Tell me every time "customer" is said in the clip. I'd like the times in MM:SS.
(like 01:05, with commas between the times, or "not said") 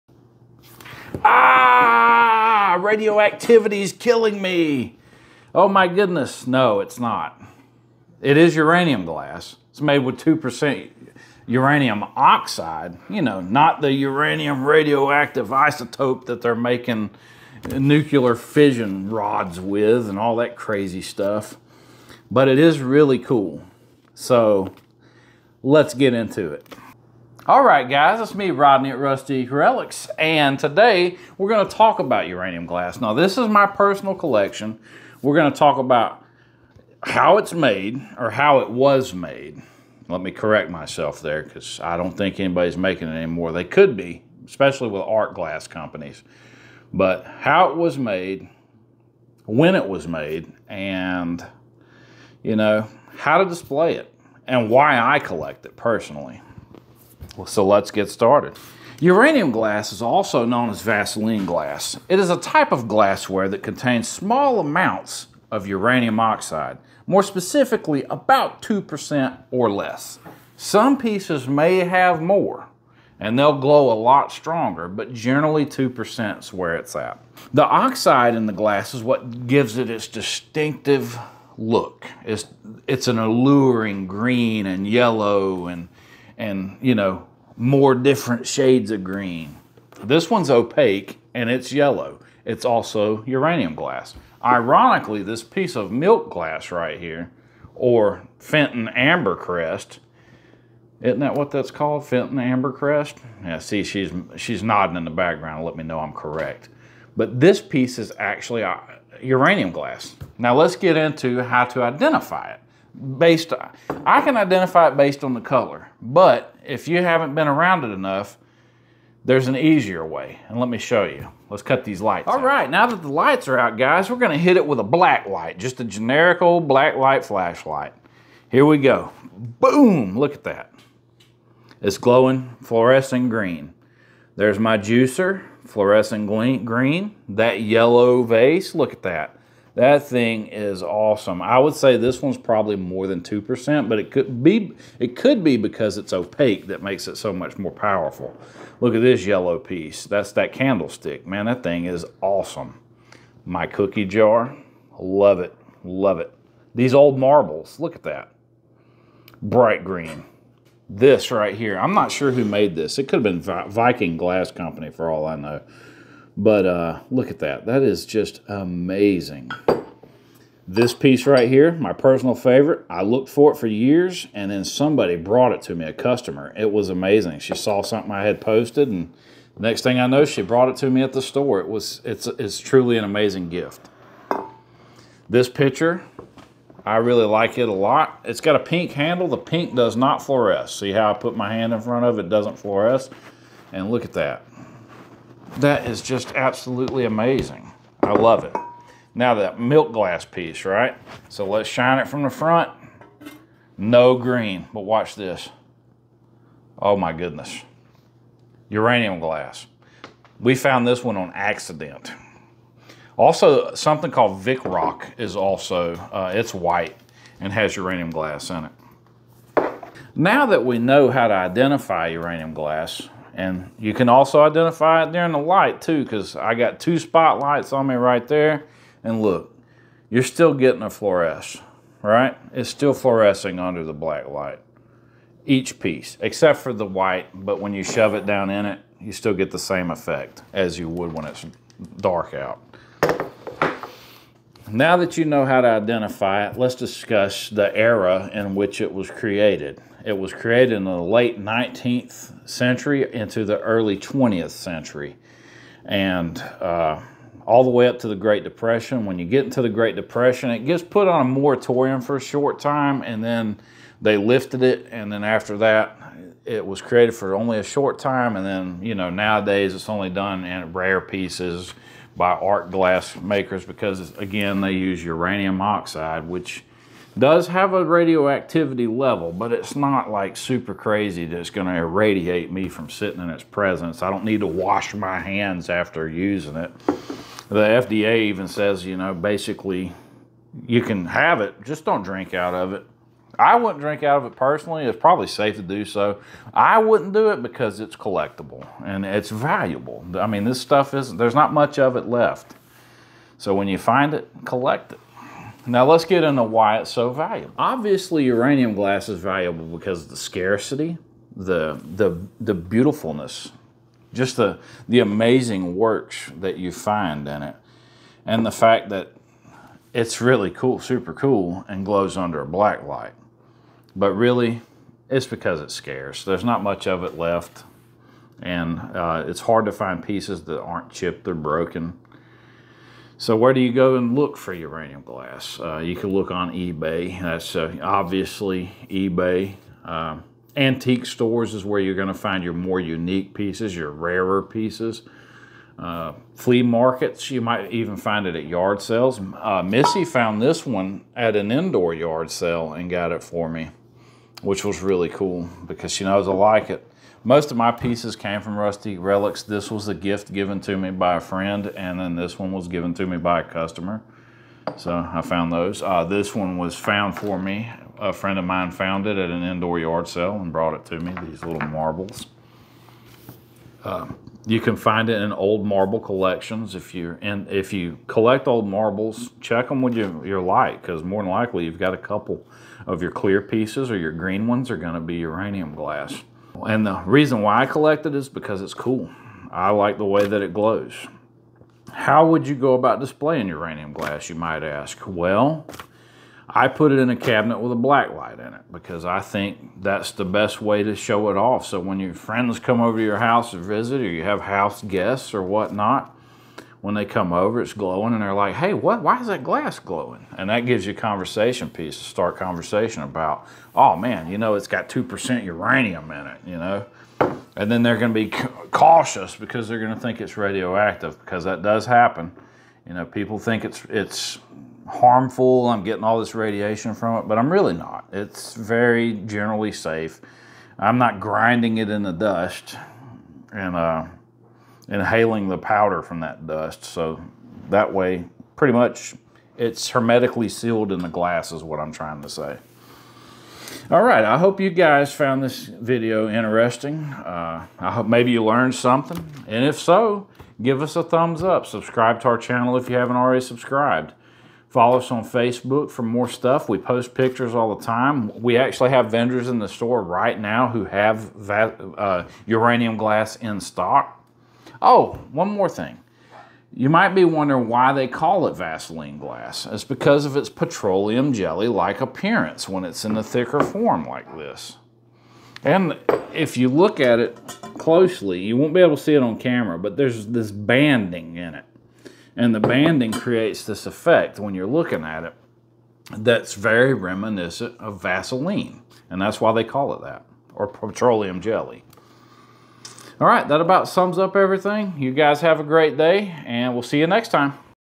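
02:55, 06:03.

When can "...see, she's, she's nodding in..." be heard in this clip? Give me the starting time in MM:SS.
01:43.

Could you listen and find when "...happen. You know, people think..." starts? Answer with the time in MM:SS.
07:01.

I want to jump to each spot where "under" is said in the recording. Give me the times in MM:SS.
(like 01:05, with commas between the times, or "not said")
03:53, 05:22.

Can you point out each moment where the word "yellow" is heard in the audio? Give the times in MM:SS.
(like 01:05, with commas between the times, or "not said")
01:24, 01:31, 02:17, 02:29.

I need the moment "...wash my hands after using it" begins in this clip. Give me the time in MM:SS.
04:44.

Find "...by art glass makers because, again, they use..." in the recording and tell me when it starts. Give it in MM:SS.
04:32.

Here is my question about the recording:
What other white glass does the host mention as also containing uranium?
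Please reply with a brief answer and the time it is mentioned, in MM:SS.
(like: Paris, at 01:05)
Vitrock, at 03:34.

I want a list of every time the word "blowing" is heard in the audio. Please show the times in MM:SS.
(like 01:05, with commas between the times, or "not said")
not said.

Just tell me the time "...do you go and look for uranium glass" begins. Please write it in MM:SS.
05:33.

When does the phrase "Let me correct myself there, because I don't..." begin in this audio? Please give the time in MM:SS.
00:40.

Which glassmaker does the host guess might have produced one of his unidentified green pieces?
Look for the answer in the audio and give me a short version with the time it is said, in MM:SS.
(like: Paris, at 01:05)
Viking Glass Company, at 02:43.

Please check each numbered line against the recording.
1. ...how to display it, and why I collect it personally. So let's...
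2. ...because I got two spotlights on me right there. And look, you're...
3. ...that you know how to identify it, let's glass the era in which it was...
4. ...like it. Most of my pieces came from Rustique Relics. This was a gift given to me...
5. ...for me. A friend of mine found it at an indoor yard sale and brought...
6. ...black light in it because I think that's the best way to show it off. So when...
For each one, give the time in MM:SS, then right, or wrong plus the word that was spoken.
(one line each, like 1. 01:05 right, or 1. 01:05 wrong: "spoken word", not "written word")
1. 00:53 right
2. 03:46 right
3. 04:04 wrong: "discuss", not "glass"
4. 05:56 right
5. 06:07 right
6. 06:37 right.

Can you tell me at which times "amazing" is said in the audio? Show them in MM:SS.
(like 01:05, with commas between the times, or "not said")
02:48, 02:56, 03:03, 03:17, 05:14.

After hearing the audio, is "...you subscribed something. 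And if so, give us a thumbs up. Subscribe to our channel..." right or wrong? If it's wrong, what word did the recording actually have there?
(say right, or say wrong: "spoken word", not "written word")
wrong: "learned", not "subscribed".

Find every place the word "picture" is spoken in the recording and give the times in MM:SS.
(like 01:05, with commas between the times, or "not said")
03:05, 07:37.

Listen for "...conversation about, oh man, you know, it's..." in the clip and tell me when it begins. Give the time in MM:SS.
06:52.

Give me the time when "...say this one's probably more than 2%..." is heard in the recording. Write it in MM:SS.
02:21.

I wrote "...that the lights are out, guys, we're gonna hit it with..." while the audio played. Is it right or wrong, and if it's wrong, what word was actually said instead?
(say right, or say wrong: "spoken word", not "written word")
right.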